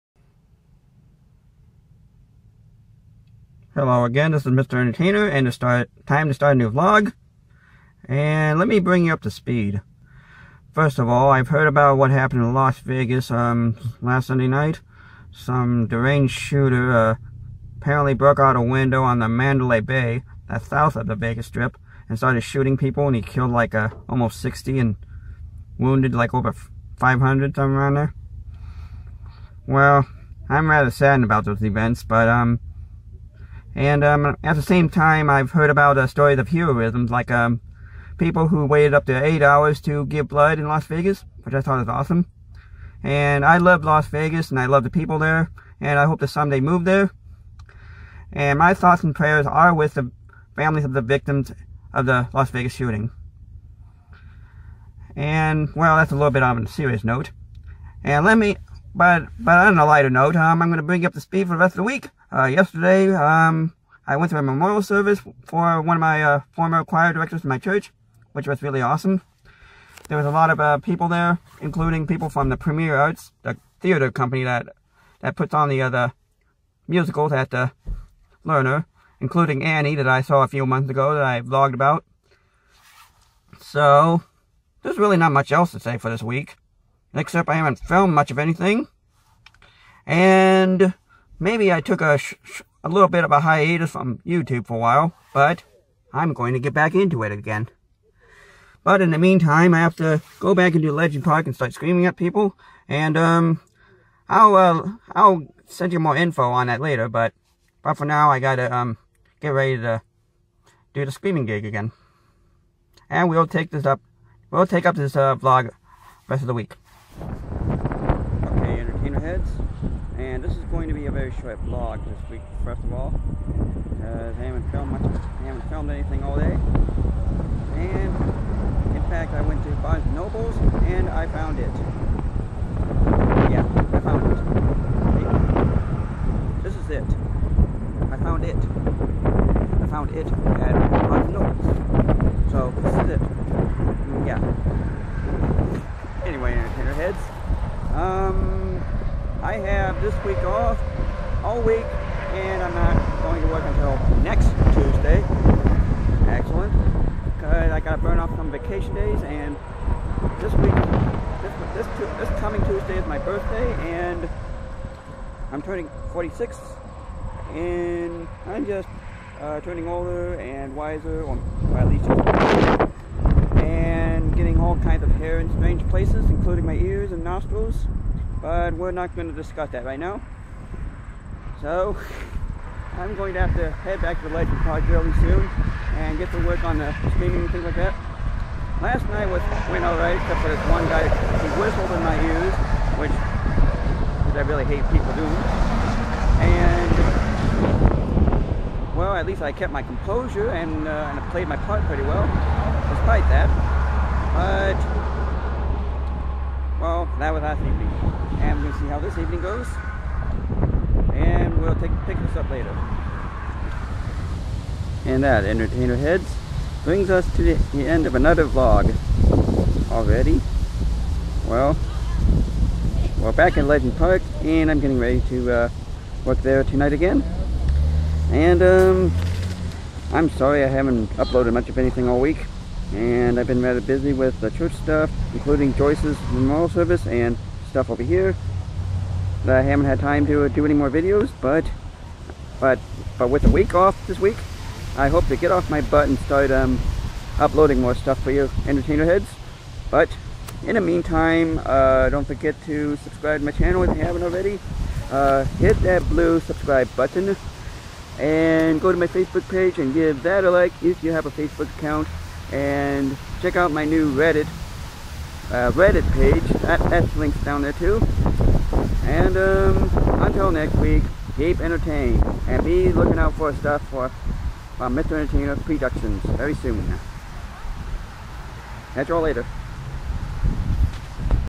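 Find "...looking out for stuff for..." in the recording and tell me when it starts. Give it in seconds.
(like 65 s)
272 s.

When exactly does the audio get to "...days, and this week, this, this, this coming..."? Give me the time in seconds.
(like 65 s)
158 s.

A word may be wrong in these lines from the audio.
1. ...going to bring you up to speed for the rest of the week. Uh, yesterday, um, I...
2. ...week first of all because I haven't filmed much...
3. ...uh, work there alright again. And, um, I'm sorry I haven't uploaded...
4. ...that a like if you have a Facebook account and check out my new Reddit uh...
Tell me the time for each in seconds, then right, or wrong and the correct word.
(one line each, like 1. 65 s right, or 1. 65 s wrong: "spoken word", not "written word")
1. 60 s right
2. 122 s right
3. 225 s wrong: "tonight", not "alright"
4. 260 s right.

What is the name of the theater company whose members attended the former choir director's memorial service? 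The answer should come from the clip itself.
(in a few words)
Premier Arts.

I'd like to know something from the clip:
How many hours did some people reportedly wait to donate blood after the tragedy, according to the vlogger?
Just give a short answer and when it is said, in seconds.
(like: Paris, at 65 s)
8, at 39 s.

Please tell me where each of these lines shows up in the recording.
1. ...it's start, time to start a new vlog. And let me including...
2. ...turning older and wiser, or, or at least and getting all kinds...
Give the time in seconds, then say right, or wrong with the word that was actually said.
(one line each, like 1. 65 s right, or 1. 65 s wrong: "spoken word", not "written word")
1. 5 s wrong: "bring", not "including"
2. 169 s right.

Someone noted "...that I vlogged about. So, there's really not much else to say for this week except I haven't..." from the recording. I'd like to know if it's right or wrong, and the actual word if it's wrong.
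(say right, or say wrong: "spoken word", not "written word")
right.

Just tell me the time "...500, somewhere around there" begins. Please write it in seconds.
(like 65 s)
26 s.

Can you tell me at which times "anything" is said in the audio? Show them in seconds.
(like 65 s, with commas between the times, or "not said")
88 s, 125 s, 231 s.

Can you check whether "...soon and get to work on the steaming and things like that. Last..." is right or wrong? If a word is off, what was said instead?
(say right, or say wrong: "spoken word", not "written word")
right.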